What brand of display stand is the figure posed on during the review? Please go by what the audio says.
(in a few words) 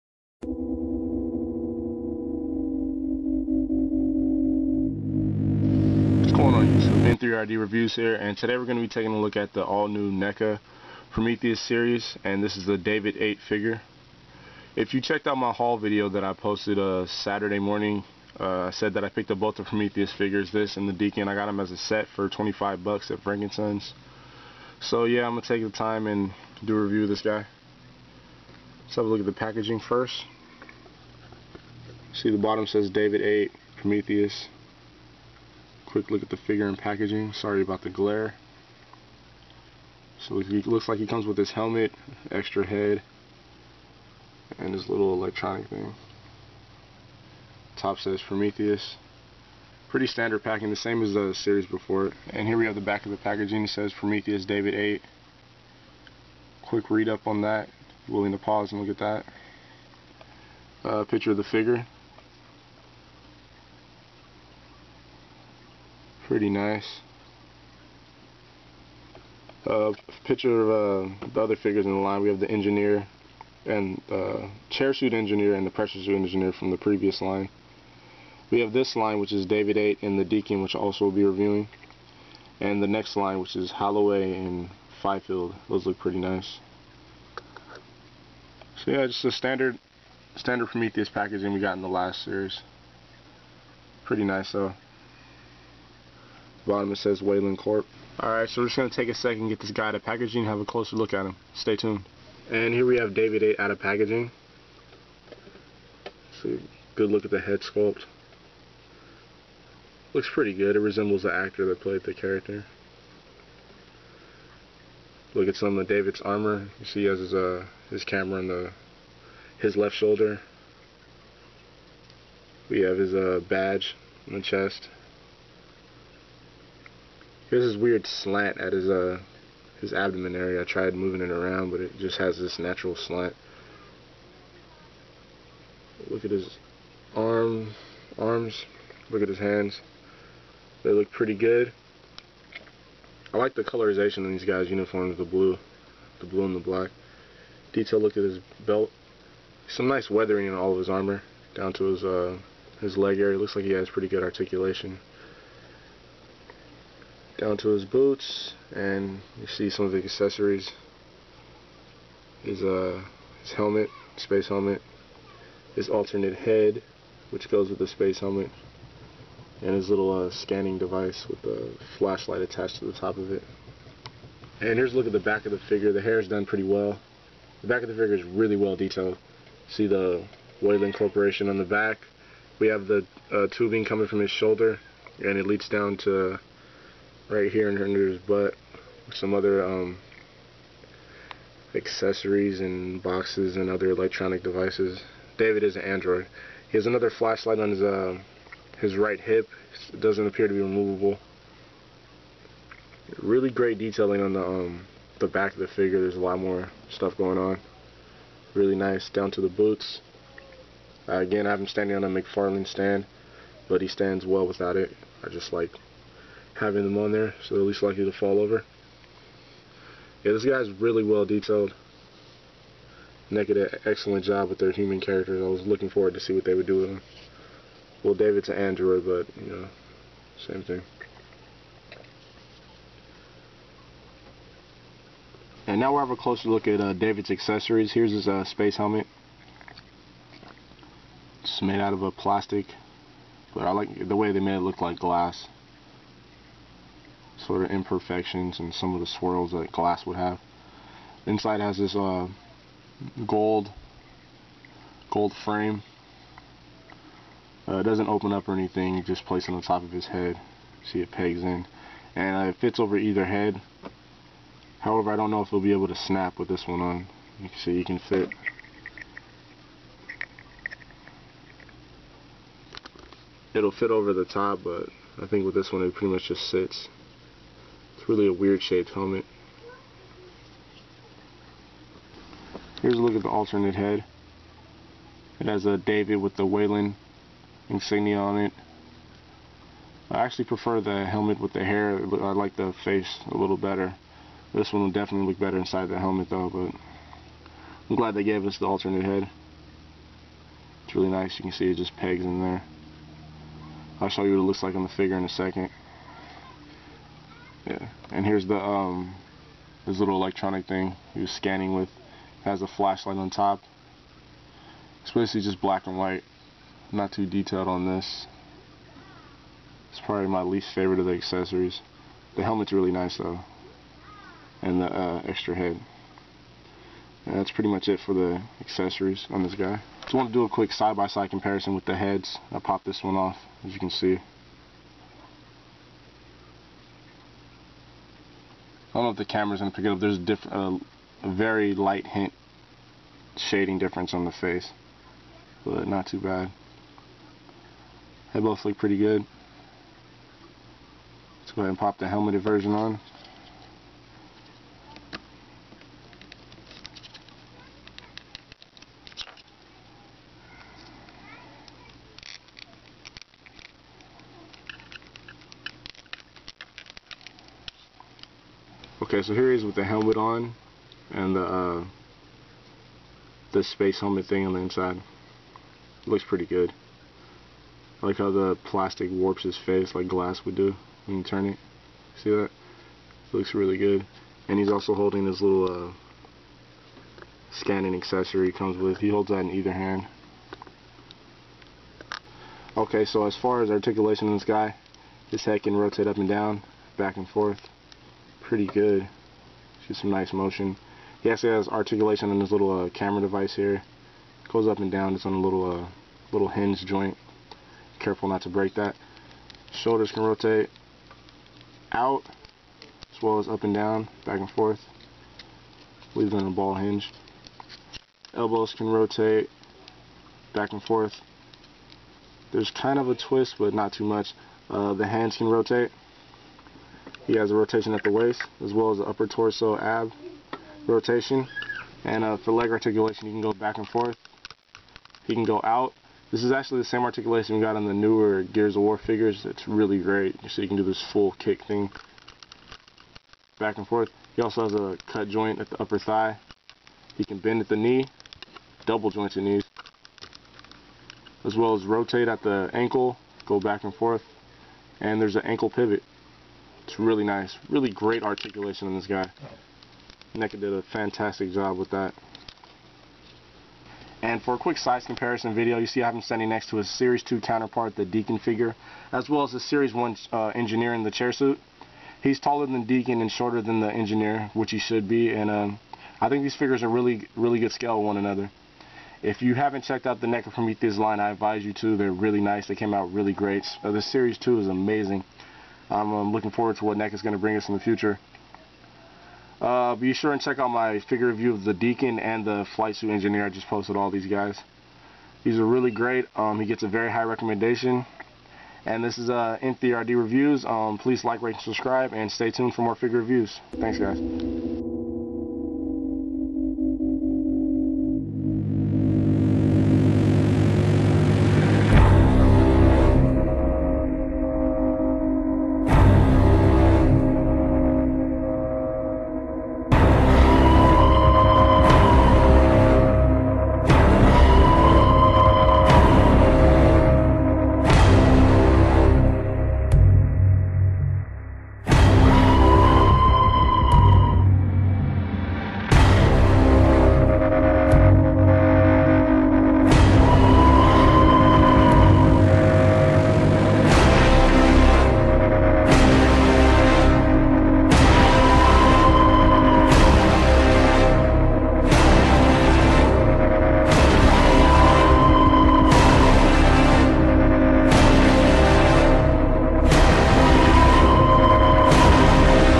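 McFarlane.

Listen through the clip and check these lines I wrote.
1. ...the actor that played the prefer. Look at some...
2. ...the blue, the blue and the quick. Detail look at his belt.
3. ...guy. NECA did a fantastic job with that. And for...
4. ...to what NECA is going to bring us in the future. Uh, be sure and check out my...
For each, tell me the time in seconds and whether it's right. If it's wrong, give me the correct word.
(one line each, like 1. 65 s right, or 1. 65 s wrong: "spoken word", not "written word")
1. 111 s wrong: "character", not "prefer"
2. 145 s wrong: "black", not "quick"
3. 459 s right
4. 486 s right.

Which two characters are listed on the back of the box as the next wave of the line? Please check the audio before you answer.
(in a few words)
Holloway and Fifield.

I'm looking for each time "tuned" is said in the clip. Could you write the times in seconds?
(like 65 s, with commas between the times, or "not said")
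101 s, 502 s.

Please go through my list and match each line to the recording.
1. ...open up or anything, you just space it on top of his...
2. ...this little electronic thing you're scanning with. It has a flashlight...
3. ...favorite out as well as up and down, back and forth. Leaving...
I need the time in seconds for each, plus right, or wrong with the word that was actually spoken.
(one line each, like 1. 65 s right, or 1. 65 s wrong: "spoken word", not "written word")
1. 258 s wrong: "place", not "space"
2. 309 s right
3. 410 s wrong: "rotate", not "favorite".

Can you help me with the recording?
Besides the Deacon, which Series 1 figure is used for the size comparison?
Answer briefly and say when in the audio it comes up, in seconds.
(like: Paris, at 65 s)
Engineer in the chair suit, at 470 s.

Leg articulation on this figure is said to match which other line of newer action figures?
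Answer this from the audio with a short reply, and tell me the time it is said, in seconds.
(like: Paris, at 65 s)
Gears of War, at 438 s.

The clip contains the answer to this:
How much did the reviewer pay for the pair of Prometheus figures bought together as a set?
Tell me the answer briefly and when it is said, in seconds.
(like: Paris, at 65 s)
$25, at 22 s.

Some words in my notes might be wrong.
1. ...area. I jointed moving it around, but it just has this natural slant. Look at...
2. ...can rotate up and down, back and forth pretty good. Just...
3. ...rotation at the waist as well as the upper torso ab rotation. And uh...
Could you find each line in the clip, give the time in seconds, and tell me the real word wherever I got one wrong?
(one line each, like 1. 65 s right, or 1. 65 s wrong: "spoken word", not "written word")
1. 130 s wrong: "tried", not "jointed"
2. 395 s right
3. 427 s right.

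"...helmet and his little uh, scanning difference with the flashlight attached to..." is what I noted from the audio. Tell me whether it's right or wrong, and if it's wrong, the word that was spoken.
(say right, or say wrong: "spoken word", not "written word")
wrong: "device", not "difference".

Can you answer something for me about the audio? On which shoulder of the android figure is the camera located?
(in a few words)
Left shoulder.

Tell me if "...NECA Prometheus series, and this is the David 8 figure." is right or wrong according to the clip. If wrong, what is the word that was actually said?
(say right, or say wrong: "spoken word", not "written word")
right.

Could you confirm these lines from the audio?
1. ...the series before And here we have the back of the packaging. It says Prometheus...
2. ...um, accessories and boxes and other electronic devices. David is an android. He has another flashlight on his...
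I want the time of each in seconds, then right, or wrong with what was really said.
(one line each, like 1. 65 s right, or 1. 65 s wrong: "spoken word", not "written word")
1. 51 s right
2. 189 s right.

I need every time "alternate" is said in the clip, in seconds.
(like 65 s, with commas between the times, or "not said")
165 s, 283 s, 298 s.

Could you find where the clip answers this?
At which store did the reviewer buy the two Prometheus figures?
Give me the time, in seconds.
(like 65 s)
23 s.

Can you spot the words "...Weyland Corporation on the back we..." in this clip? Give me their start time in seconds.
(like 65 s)
180 s.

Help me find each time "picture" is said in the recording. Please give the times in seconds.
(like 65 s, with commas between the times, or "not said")
61 s, 70 s.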